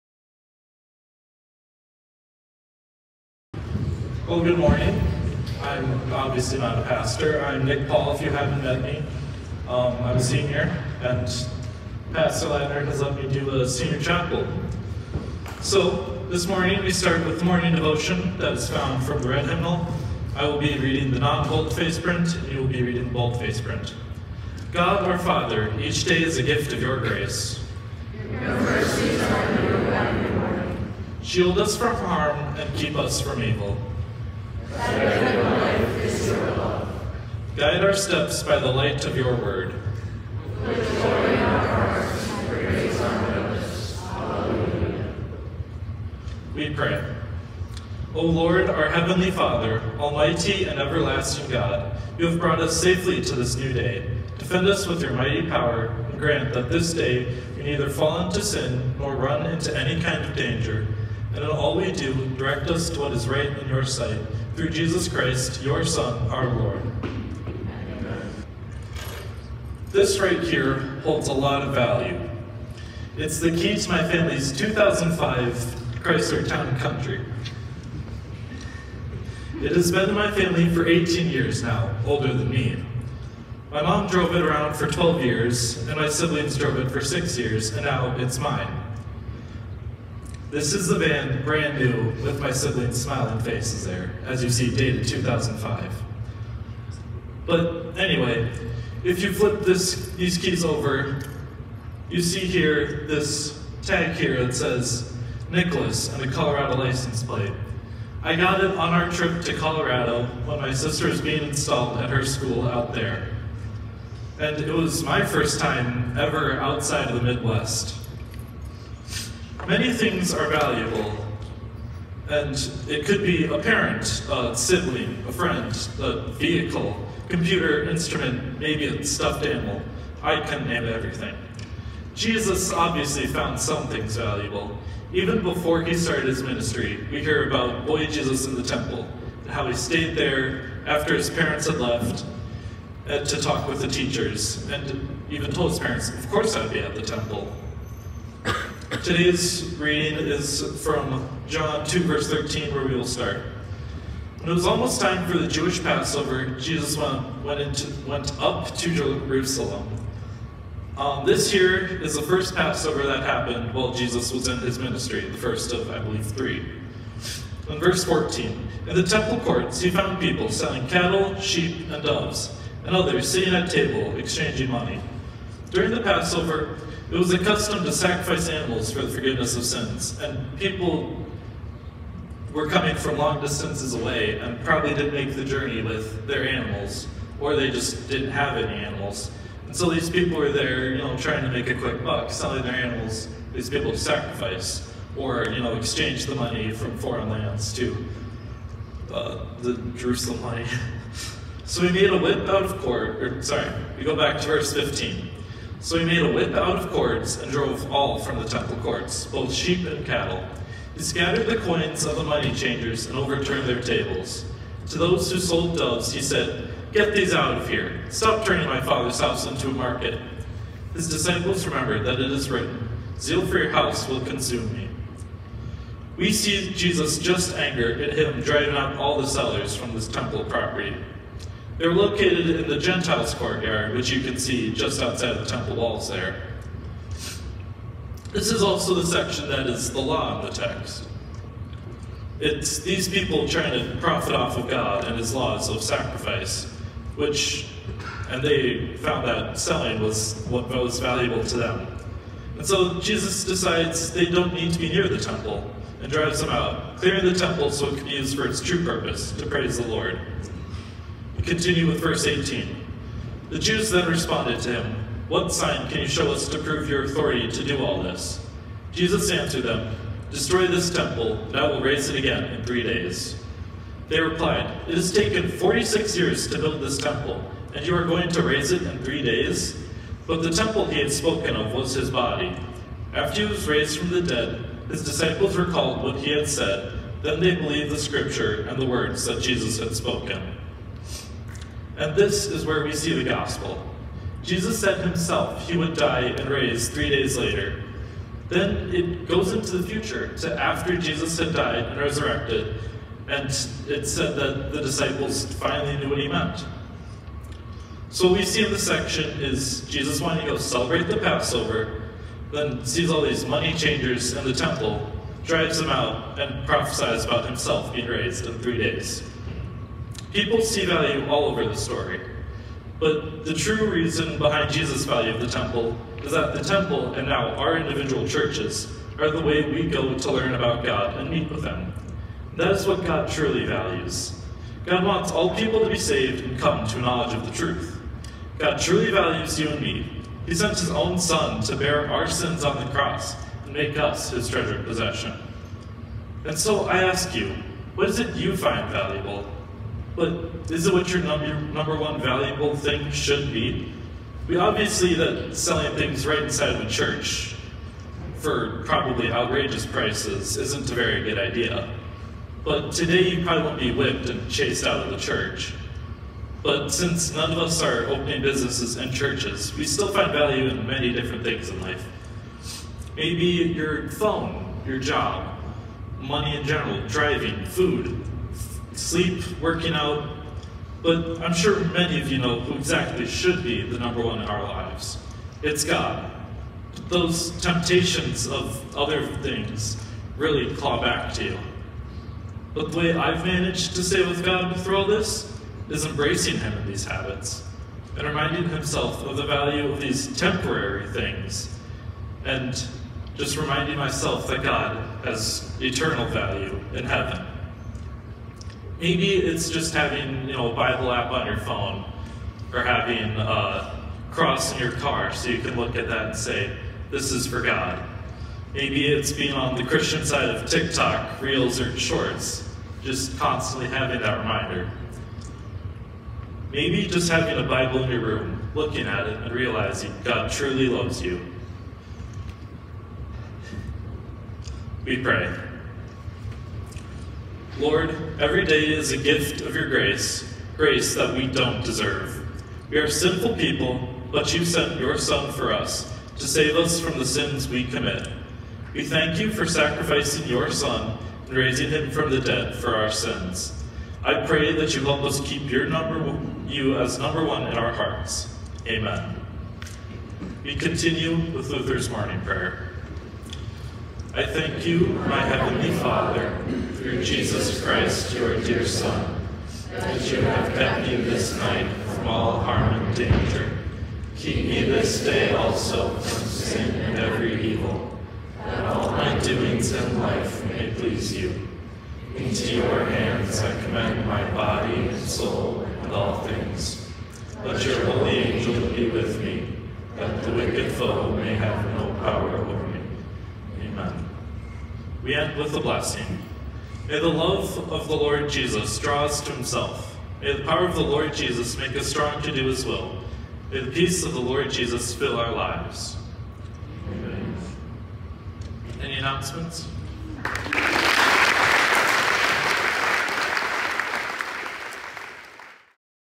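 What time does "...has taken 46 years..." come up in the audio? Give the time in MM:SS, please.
04:34.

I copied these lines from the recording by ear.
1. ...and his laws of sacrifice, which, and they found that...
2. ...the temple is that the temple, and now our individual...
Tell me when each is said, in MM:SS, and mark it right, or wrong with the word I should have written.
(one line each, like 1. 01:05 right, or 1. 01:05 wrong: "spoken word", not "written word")
1. 04:05 right
2. 05:25 right.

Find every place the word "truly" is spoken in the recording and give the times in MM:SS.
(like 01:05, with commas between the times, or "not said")
05:33, 05:38, 07:10.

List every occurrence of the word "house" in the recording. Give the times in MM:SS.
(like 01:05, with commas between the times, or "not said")
03:39, 03:43.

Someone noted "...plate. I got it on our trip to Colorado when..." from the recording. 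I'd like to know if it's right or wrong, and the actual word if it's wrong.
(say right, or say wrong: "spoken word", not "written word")
right.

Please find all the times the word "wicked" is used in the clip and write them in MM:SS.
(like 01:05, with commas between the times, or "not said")
08:10.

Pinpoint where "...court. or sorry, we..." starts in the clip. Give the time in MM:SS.
03:22.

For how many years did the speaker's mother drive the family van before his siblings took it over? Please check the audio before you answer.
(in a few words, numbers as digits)
12.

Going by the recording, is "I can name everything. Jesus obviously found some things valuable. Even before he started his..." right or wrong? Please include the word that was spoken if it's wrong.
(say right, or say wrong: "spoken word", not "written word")
right.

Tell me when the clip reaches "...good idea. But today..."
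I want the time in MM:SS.
06:01.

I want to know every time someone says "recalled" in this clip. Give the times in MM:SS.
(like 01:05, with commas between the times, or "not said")
04:45.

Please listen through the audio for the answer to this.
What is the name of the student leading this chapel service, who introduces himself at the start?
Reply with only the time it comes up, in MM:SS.
00:07.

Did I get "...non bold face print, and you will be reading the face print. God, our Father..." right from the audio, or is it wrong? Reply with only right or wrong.
right.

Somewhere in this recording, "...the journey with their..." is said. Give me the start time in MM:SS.
03:05.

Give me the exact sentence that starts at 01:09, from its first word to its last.
This right here holds a lot of value.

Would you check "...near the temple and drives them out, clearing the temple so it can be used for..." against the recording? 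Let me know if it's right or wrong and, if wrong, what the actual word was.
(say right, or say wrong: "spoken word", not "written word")
right.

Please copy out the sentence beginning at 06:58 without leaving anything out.
Maybe it's being on the Christian side of TikTok, Reels, or Shorts, just constantly having that reminder.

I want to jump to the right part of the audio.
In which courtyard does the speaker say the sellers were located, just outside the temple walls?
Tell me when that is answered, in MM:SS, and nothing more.
03:52.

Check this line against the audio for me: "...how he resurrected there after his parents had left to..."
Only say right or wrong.
wrong.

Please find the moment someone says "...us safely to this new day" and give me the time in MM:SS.
00:52.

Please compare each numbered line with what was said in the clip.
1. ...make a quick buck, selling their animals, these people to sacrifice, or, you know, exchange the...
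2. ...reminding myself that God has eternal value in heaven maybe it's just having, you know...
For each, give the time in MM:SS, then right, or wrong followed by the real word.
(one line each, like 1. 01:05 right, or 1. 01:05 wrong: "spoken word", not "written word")
1. 03:11 right
2. 06:43 right.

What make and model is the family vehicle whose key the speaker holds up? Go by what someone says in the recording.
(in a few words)
Chrysler Town Country.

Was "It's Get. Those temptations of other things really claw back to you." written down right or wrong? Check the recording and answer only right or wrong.
wrong.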